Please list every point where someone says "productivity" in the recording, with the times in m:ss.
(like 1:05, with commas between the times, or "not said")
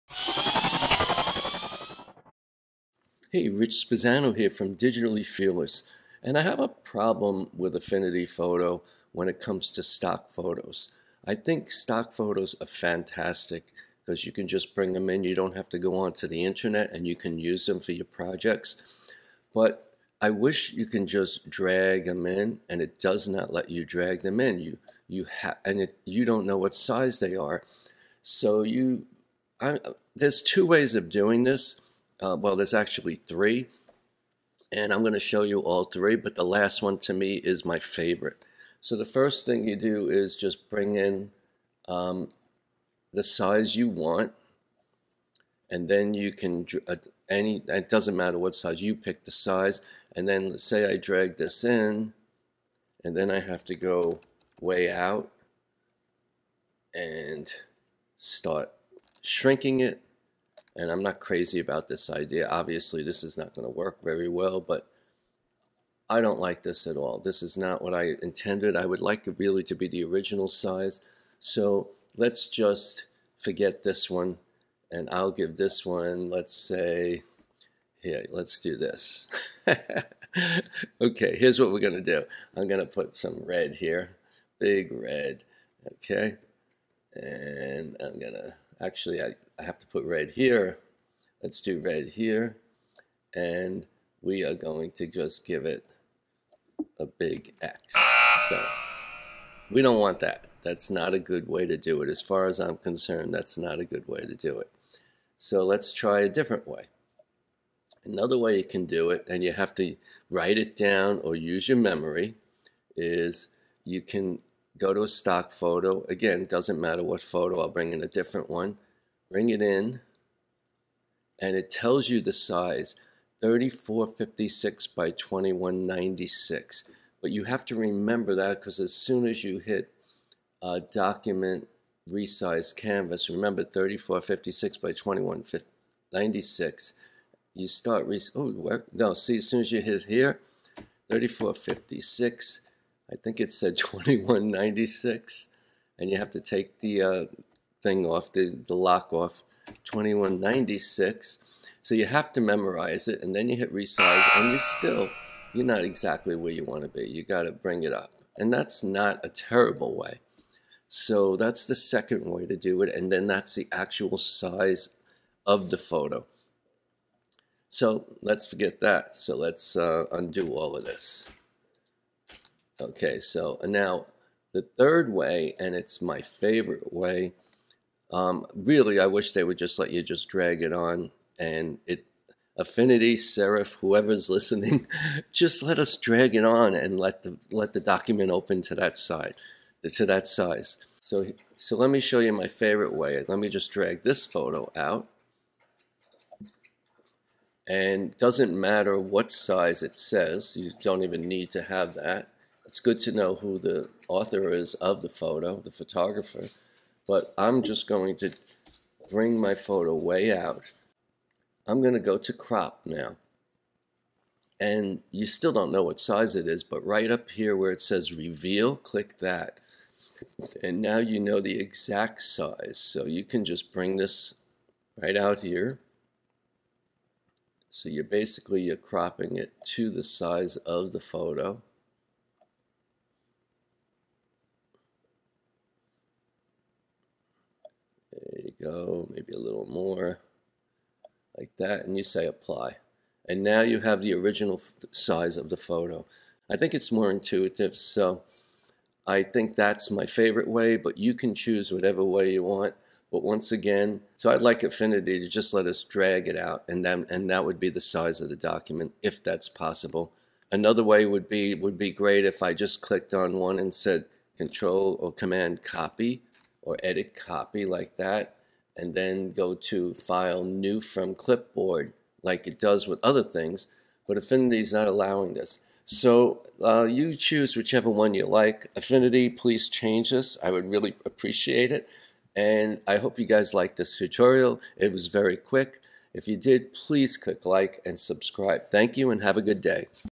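not said.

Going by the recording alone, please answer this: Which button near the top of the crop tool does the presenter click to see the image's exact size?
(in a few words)
reveal.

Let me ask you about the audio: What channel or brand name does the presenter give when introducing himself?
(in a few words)
Digitally Fearless.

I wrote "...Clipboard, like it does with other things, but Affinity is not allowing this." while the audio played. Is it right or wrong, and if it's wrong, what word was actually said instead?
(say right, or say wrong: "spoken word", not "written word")
right.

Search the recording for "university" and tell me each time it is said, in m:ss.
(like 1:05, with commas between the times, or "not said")
not said.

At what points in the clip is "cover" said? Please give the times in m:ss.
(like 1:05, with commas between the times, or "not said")
not said.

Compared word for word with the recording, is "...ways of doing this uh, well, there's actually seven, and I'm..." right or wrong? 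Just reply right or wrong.
wrong.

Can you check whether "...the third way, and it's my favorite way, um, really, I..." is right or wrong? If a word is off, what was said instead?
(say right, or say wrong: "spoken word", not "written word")
right.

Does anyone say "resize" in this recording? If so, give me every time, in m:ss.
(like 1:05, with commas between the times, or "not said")
2:12, 2:33.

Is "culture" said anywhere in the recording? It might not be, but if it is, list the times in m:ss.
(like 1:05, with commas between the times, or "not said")
not said.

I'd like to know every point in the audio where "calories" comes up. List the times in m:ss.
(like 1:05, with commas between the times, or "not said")
not said.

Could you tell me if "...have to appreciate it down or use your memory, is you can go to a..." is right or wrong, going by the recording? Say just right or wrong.
wrong.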